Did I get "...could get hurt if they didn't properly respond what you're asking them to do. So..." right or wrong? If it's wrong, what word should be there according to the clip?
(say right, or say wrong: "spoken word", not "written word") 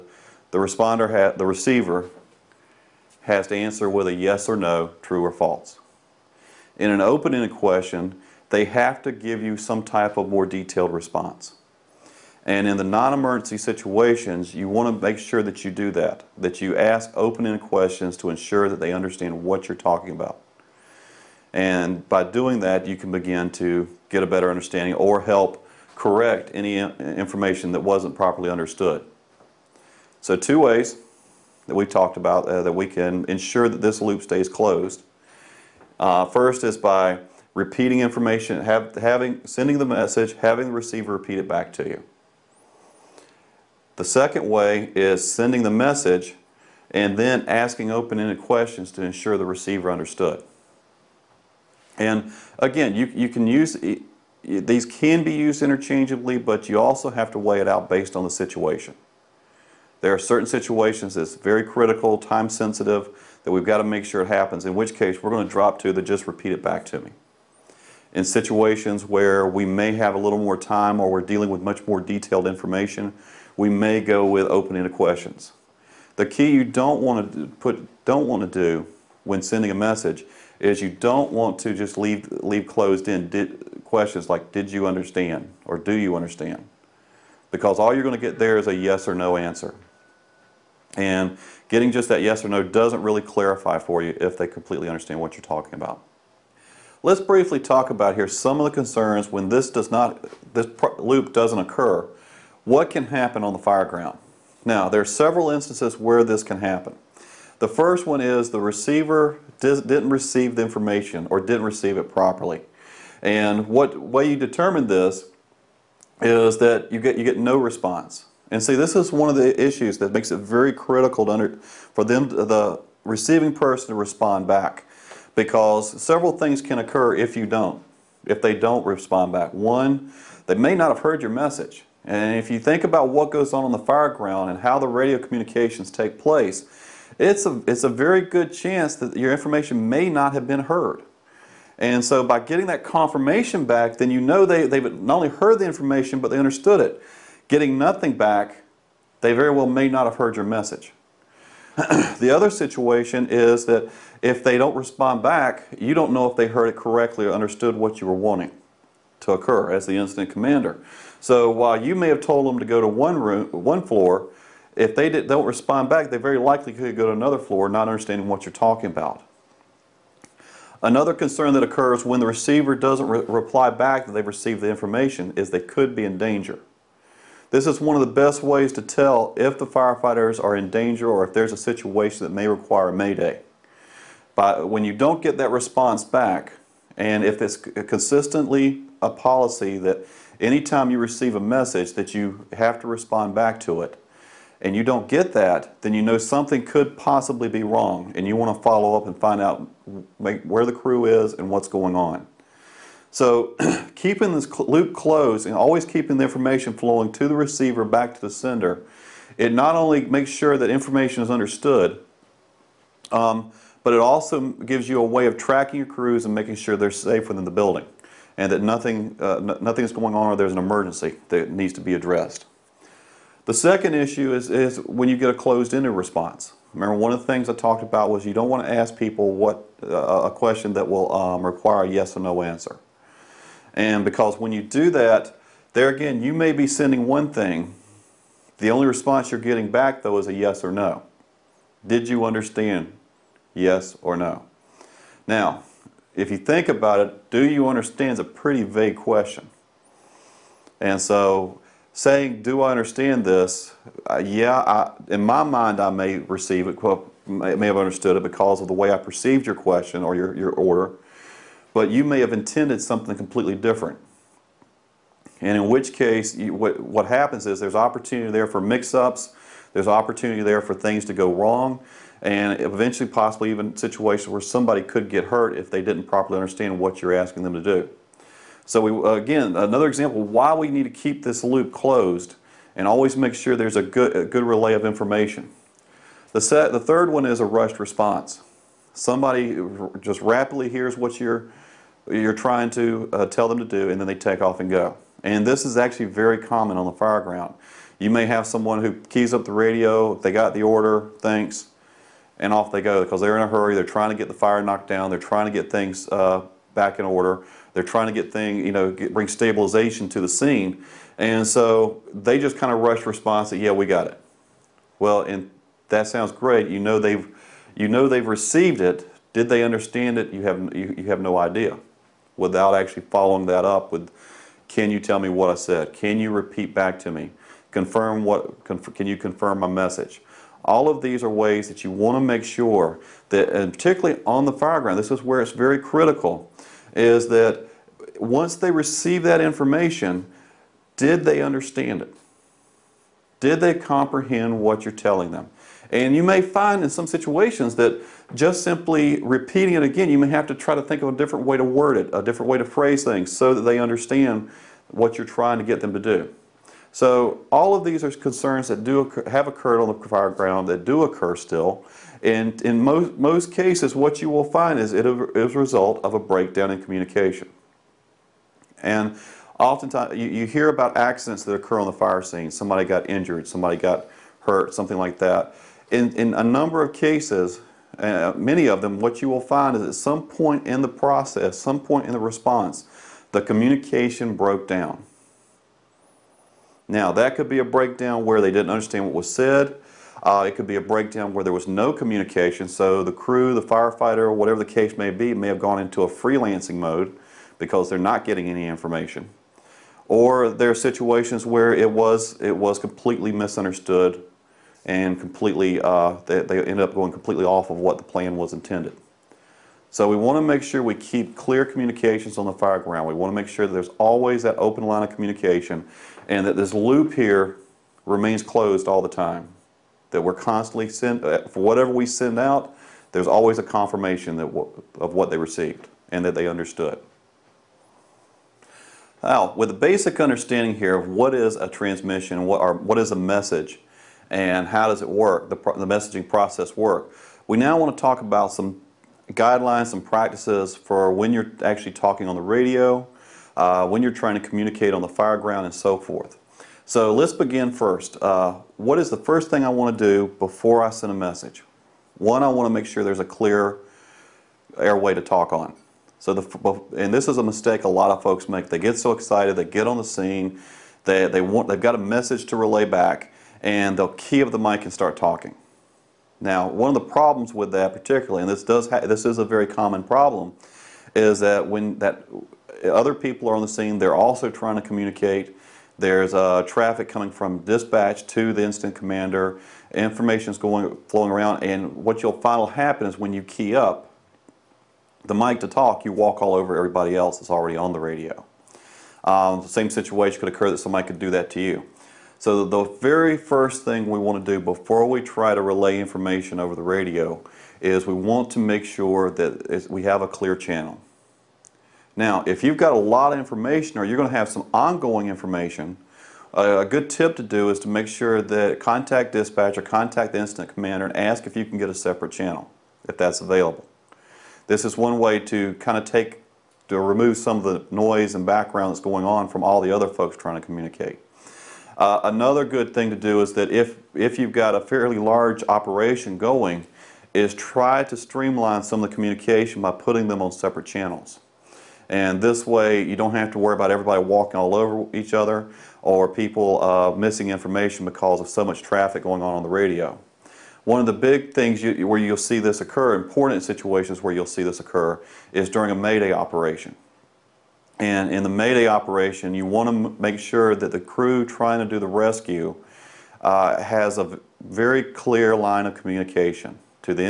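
wrong: "understand", not "respond".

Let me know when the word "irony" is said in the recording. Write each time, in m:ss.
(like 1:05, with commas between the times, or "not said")
not said.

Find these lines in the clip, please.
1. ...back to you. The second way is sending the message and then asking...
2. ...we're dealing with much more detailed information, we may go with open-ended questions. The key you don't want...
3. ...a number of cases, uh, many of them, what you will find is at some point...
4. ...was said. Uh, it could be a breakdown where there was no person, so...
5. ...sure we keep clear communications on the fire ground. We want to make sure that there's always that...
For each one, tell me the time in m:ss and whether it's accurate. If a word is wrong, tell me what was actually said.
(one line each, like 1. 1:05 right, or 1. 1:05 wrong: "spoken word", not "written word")
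1. 0:41 right
2. 1:11 right
3. 6:16 right
4. 6:29 wrong: "communication", not "person"
5. 6:50 right.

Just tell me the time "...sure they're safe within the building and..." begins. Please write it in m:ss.
3:36.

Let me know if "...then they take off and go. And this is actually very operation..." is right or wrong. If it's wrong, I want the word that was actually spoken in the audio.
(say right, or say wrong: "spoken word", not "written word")
wrong: "common", not "operation".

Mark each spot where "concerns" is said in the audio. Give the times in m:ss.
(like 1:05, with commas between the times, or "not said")
1:38, 2:51, 5:58.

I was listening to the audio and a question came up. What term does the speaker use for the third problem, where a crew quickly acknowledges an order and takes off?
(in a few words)
Rushed response.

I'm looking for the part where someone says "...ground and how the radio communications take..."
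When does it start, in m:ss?
2:14.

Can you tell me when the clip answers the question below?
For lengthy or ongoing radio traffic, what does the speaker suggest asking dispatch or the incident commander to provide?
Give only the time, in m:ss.
8:31.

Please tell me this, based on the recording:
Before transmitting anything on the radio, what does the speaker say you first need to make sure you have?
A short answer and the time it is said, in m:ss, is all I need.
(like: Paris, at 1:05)
A clear airway, at 7:33.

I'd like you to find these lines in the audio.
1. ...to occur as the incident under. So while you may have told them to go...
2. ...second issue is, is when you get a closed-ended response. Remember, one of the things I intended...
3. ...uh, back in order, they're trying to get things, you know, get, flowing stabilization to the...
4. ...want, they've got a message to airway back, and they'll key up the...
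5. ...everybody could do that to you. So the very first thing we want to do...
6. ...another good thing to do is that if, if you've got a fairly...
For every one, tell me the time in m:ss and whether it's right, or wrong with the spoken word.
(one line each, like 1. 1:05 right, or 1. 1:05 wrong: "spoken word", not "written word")
1. 2:39 wrong: "commander", not "under"
2. 3:43 wrong: "talked", not "intended"
3. 5:06 wrong: "bring", not "flowing"
4. 7:41 wrong: "relay", not "airway"
5. 8:10 wrong: "somebody", not "everybody"
6. 8:42 right.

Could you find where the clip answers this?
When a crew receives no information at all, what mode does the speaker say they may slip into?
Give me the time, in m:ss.
6:36.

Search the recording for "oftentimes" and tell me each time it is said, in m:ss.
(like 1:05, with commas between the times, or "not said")
6:09.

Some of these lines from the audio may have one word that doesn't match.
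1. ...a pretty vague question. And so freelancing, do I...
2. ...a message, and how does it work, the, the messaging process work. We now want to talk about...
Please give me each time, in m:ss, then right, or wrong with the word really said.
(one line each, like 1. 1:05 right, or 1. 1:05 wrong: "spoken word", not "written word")
1. 4:08 wrong: "saying", not "freelancing"
2. 7:13 right.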